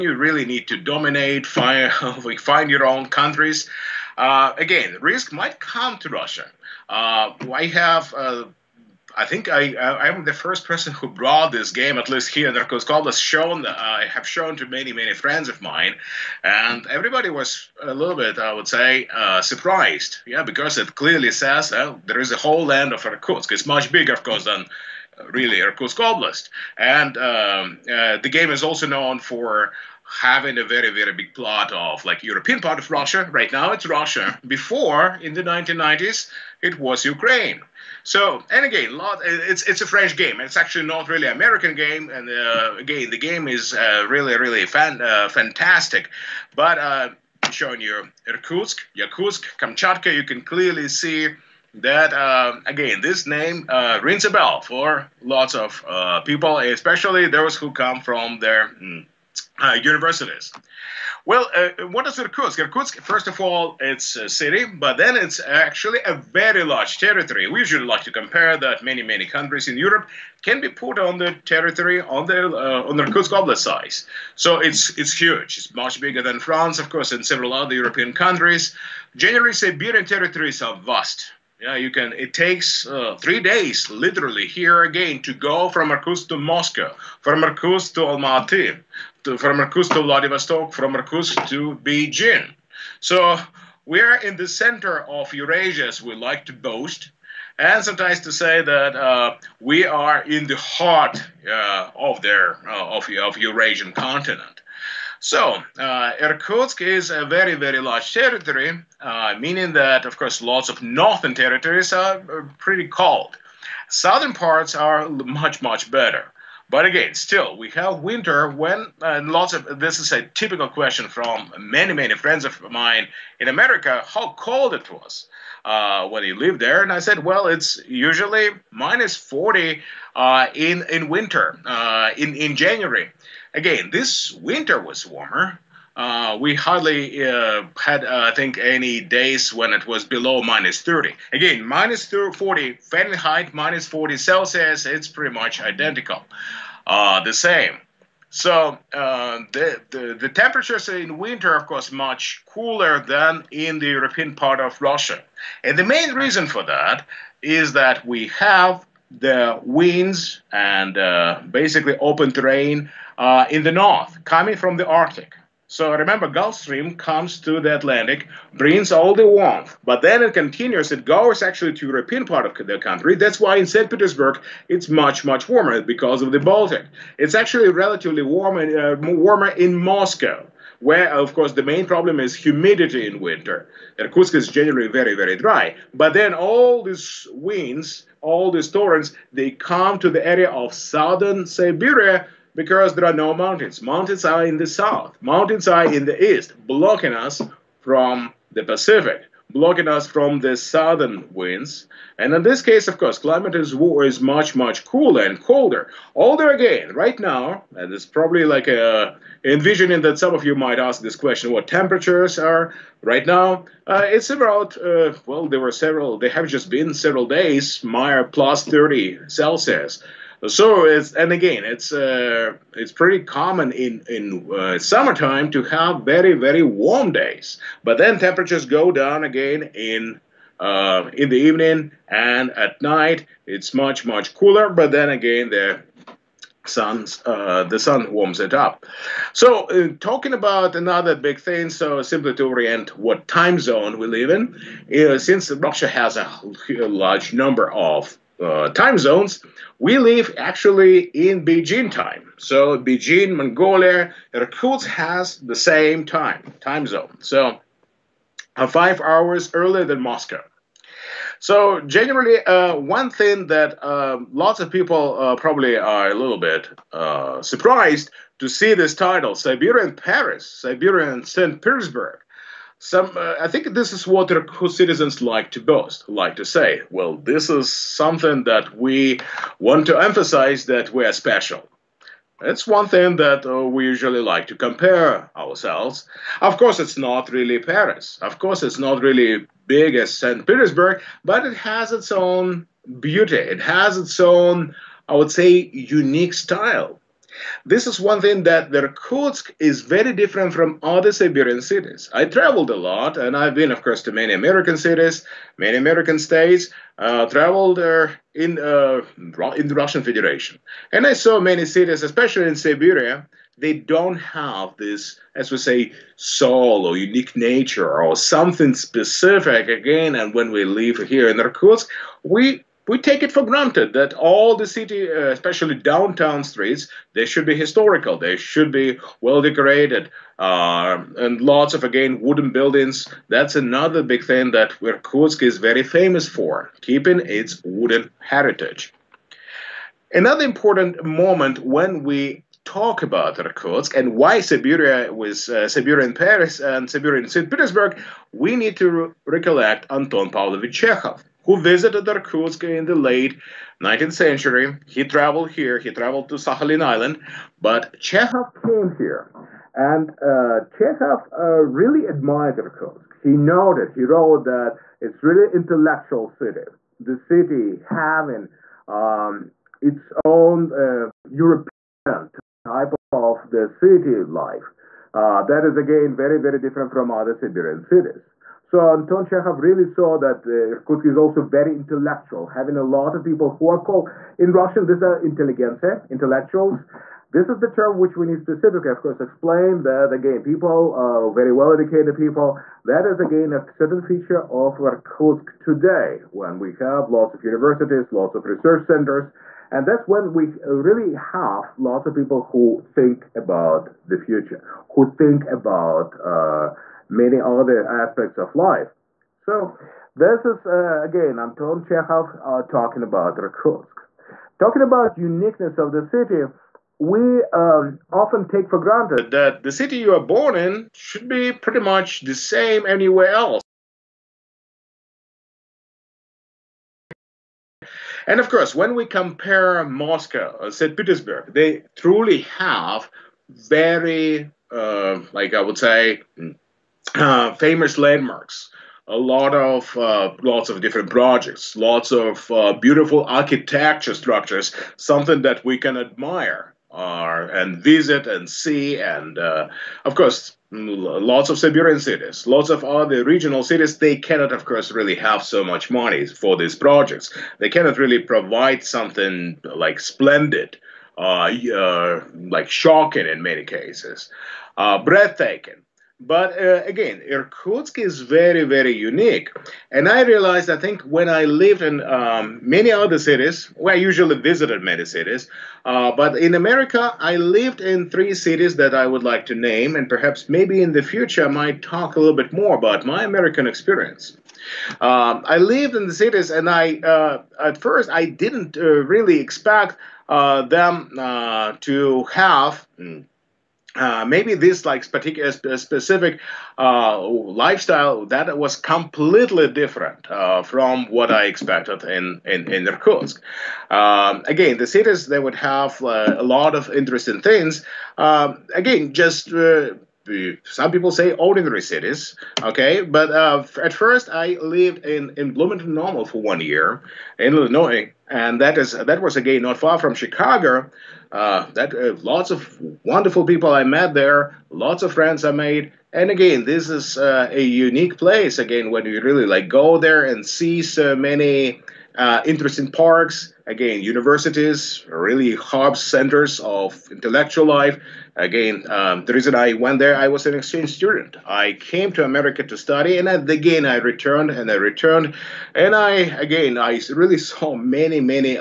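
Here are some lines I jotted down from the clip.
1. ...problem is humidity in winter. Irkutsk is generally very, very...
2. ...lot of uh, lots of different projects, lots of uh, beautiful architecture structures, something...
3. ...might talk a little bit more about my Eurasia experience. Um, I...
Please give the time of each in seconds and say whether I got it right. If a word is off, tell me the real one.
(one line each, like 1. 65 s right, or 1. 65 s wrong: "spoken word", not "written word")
1. 181 s right
2. 439 s right
3. 481 s wrong: "American", not "Eurasia".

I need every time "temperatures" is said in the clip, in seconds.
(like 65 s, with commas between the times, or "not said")
150 s, 211 s, 228 s.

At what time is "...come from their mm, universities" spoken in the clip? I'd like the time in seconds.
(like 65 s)
57 s.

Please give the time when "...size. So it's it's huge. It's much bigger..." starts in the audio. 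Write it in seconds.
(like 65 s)
73 s.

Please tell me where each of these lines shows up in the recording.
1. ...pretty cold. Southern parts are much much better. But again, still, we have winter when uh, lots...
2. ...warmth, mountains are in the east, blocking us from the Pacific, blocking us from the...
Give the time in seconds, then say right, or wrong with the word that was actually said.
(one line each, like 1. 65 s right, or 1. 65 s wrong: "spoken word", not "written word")
1. 112 s right
2. 194 s wrong: "south", not "warmth".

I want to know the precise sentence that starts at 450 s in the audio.
Lots of Siberian cities, lots of other regional cities, they cannot, of course, really have so much money for these projects.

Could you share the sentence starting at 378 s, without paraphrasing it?
So Anton Chekhov really saw that uh, Irkutsk is also very intellectual, having a lot of people who are called in Russian.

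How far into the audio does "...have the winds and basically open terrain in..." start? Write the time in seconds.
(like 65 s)
158 s.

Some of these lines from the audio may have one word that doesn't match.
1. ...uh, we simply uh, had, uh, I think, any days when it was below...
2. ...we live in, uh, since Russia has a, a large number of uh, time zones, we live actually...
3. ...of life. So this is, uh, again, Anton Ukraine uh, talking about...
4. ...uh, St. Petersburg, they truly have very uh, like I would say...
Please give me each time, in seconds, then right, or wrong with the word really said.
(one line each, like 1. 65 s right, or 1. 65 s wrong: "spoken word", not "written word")
1. 135 s wrong: "hardly", not "simply"
2. 243 s right
3. 408 s wrong: "Chekhov", not "Ukraine"
4. 430 s right.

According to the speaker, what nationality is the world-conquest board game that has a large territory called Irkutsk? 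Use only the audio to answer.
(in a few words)
French.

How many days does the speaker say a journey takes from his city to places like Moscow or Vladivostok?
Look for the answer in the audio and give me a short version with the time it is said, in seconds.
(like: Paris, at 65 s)
3, at 83 s.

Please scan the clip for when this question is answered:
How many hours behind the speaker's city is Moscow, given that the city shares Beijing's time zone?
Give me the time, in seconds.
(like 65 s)
258 s.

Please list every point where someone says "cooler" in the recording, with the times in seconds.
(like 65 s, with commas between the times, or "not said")
152 s, 204 s, 234 s.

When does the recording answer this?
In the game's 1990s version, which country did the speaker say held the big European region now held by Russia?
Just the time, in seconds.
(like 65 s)
37 s.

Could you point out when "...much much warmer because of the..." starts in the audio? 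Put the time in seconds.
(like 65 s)
174 s.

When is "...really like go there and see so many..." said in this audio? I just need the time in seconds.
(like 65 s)
529 s.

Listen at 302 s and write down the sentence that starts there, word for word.
I traveled a lot, and I've been, of course, to many American cities, many American states.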